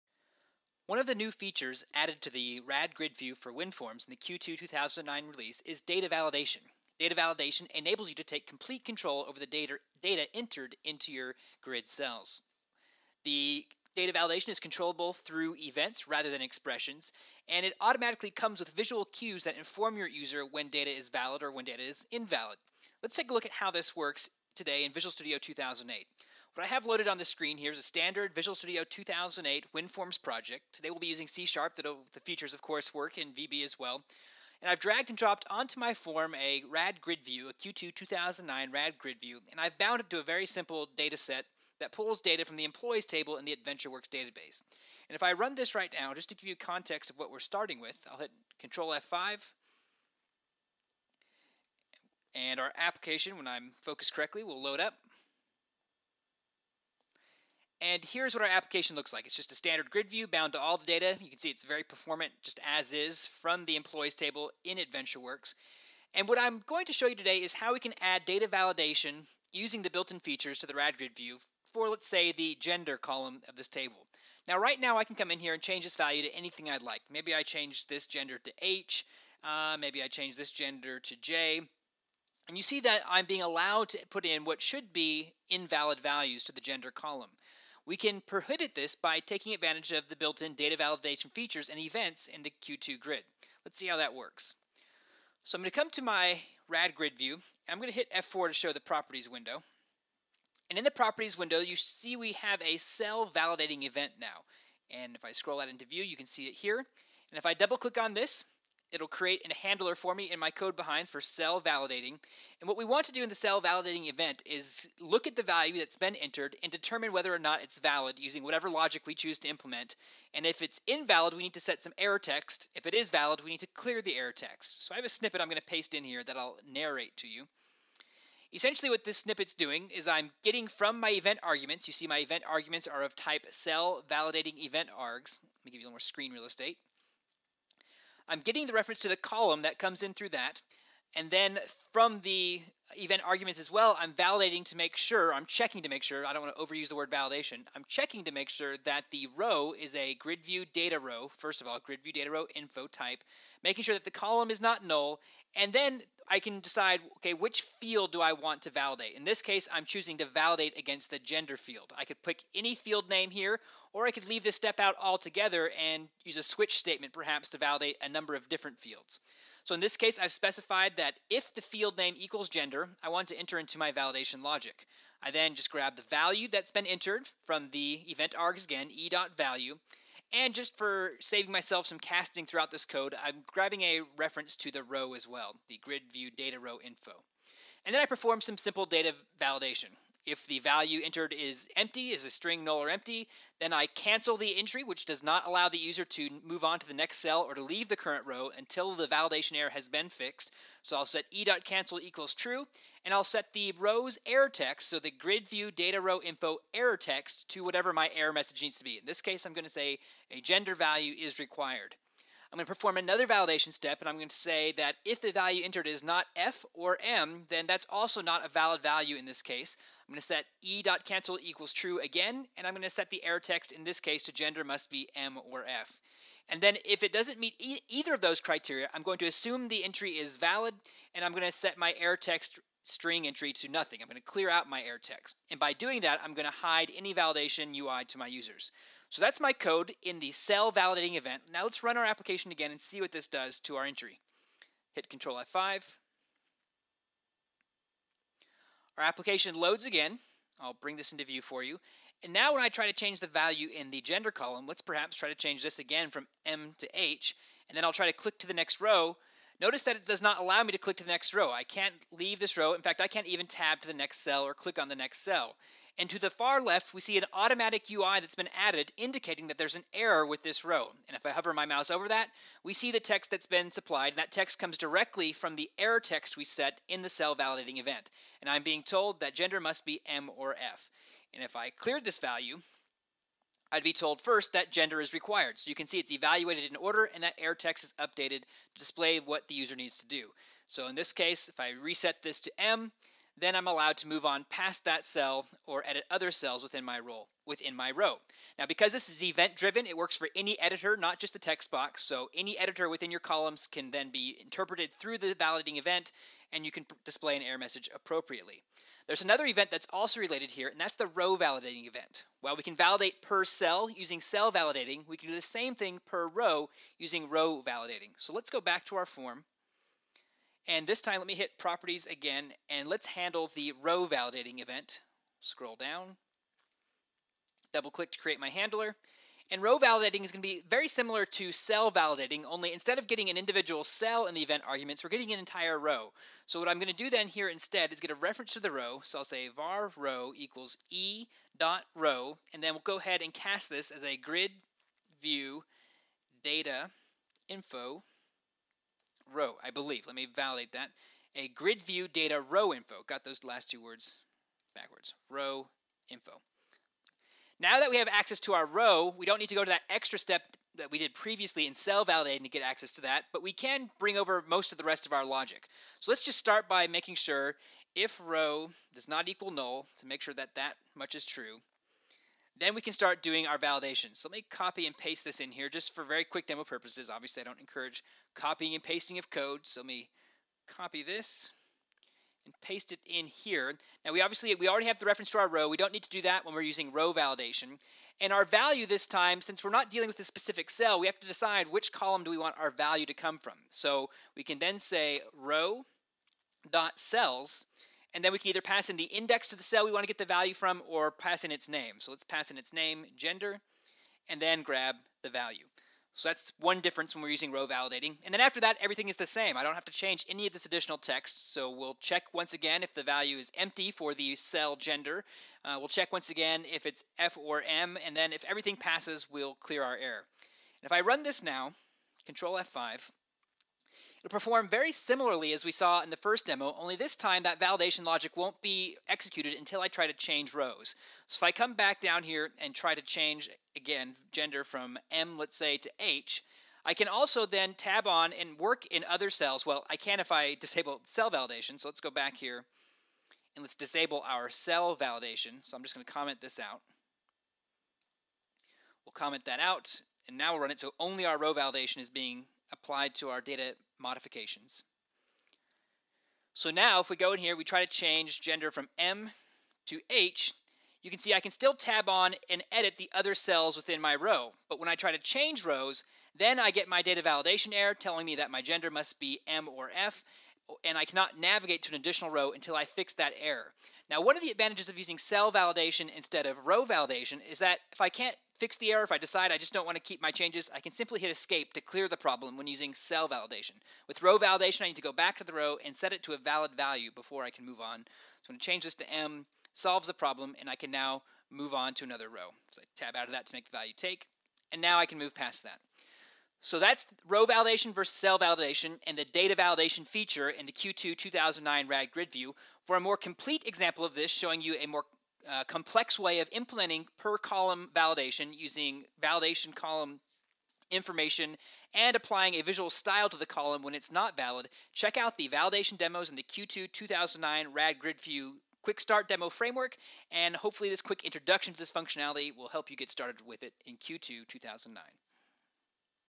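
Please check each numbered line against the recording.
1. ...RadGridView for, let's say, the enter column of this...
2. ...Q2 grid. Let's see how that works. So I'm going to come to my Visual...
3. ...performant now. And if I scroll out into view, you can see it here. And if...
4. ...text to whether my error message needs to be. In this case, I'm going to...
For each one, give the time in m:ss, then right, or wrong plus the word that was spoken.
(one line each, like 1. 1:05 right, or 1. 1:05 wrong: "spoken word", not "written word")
1. 1:10 wrong: "gender", not "enter"
2. 1:32 wrong: "RadGridView", not "Visual"
3. 1:43 wrong: "event", not "performant"
4. 3:26 wrong: "whatever", not "whether".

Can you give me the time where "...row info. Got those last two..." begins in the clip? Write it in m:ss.
5:52.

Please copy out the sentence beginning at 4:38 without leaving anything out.
And I'm being told that gender must be M or F.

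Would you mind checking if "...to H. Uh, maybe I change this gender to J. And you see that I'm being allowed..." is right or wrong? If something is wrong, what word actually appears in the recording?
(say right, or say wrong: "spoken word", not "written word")
right.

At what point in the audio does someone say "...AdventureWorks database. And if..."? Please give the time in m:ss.
0:43.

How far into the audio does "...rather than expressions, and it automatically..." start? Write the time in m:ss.
0:16.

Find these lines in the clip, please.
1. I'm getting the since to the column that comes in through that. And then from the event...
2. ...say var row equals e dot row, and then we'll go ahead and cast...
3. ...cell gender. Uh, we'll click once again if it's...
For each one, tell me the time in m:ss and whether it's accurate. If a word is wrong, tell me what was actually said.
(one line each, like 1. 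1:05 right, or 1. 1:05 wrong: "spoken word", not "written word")
1. 2:18 wrong: "reference", not "since"
2. 5:39 right
3. 6:54 wrong: "check", not "click".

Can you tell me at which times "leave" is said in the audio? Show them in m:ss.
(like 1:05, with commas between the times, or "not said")
2:44, 3:17, 4:22.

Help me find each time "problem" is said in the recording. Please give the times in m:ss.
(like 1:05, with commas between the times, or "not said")
8:02, 8:10.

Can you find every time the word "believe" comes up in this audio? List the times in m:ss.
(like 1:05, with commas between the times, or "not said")
5:49.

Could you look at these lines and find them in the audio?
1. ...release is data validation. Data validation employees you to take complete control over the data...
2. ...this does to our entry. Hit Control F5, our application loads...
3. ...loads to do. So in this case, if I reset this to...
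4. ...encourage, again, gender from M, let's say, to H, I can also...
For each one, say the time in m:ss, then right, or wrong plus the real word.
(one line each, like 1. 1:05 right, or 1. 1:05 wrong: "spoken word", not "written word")
1. 0:05 wrong: "enables", not "employees"
2. 4:03 right
3. 4:49 wrong: "needs", not "loads"
4. 7:13 wrong: "change", not "encourage".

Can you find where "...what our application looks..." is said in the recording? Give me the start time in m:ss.
0:58.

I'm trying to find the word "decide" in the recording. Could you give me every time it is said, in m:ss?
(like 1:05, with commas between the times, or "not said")
2:36, 6:31, 7:59.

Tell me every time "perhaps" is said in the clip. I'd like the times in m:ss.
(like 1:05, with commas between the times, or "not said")
2:47, 4:14.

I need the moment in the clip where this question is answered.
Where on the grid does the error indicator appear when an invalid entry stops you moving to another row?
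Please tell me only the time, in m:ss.
4:26.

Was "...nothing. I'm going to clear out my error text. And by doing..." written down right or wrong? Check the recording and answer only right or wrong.
right.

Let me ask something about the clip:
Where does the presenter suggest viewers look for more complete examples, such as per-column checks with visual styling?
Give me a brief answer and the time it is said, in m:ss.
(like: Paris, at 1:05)
quick start demo framework, at 8:38.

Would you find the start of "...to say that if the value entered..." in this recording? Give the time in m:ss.
3:34.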